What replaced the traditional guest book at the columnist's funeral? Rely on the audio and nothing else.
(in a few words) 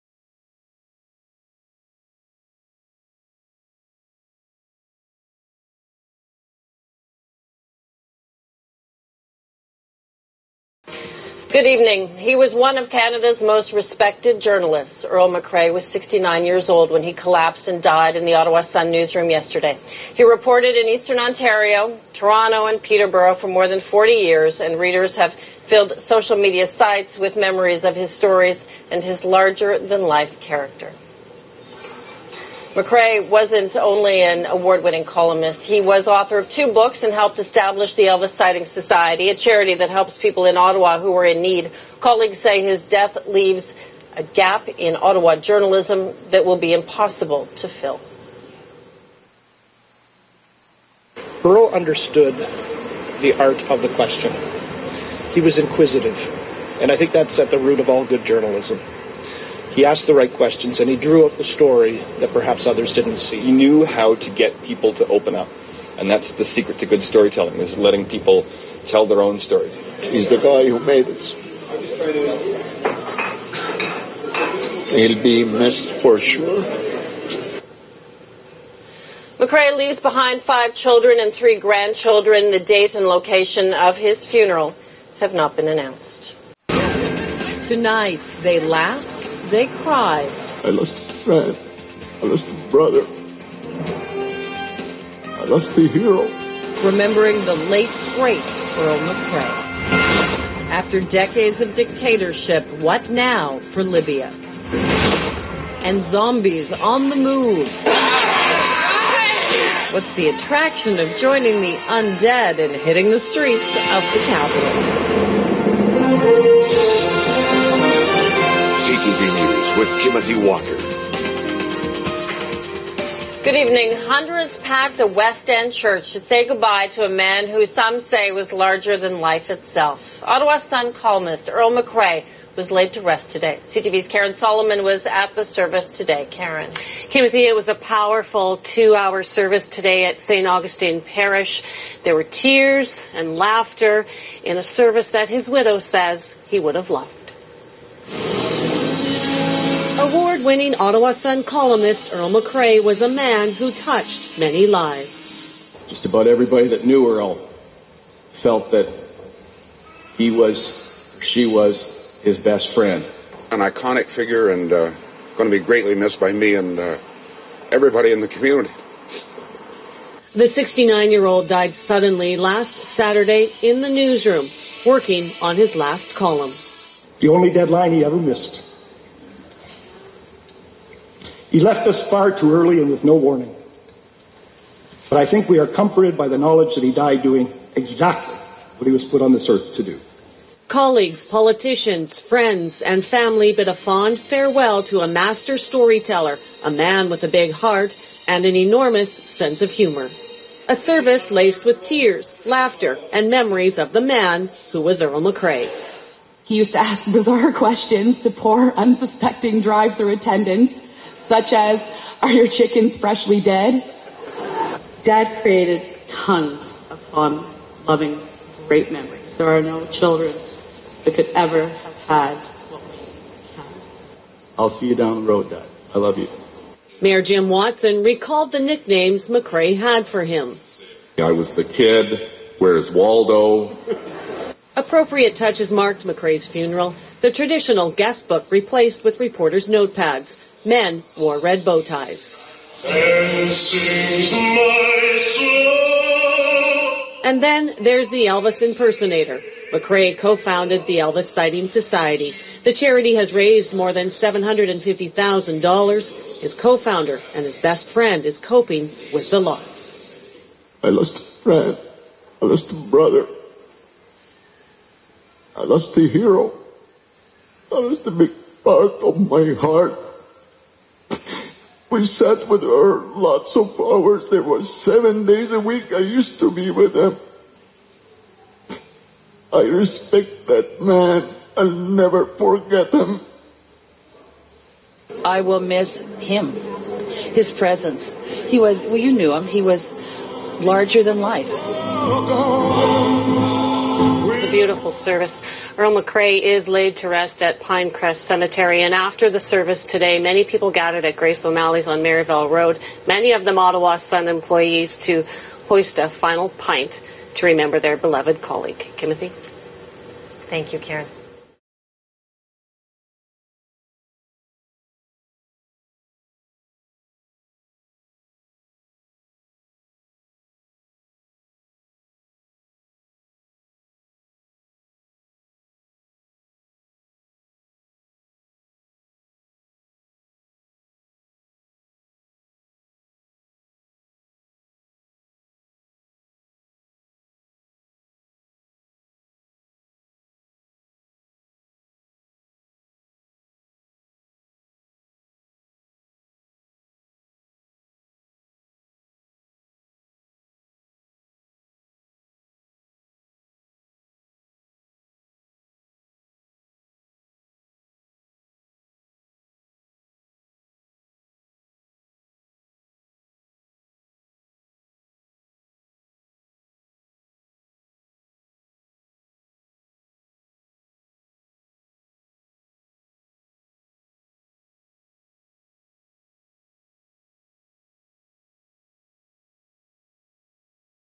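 reporters' notepads.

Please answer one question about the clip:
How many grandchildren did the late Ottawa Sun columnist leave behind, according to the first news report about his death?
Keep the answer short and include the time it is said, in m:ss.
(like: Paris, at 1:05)
3, at 1:21.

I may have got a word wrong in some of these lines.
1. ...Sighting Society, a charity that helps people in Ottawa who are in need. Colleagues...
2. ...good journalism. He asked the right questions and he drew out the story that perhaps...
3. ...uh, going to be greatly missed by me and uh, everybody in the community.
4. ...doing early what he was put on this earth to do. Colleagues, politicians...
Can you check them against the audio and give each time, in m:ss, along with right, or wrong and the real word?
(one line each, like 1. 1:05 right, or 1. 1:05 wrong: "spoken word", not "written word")
1. 0:38 right
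2. 0:58 right
3. 2:44 right
4. 3:07 wrong: "exactly", not "early".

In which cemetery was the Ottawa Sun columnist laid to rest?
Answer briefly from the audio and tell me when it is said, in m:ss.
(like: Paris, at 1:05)
Pinecrest Cemetery, at 4:57.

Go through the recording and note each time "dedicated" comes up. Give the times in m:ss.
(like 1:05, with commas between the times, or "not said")
not said.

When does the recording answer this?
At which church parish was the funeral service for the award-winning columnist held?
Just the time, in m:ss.
2:20.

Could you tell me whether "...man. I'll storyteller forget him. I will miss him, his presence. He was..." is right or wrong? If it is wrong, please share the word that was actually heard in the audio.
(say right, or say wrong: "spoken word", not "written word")
wrong: "never", not "storyteller".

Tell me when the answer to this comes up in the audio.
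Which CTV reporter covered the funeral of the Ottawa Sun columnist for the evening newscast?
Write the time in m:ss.
2:14.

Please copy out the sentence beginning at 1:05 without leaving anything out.
And that's the secret to good storytelling is letting people tell their own stories.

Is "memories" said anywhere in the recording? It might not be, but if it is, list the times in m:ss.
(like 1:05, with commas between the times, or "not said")
0:27, 3:23, 3:38.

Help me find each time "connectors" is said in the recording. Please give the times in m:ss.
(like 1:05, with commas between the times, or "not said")
not said.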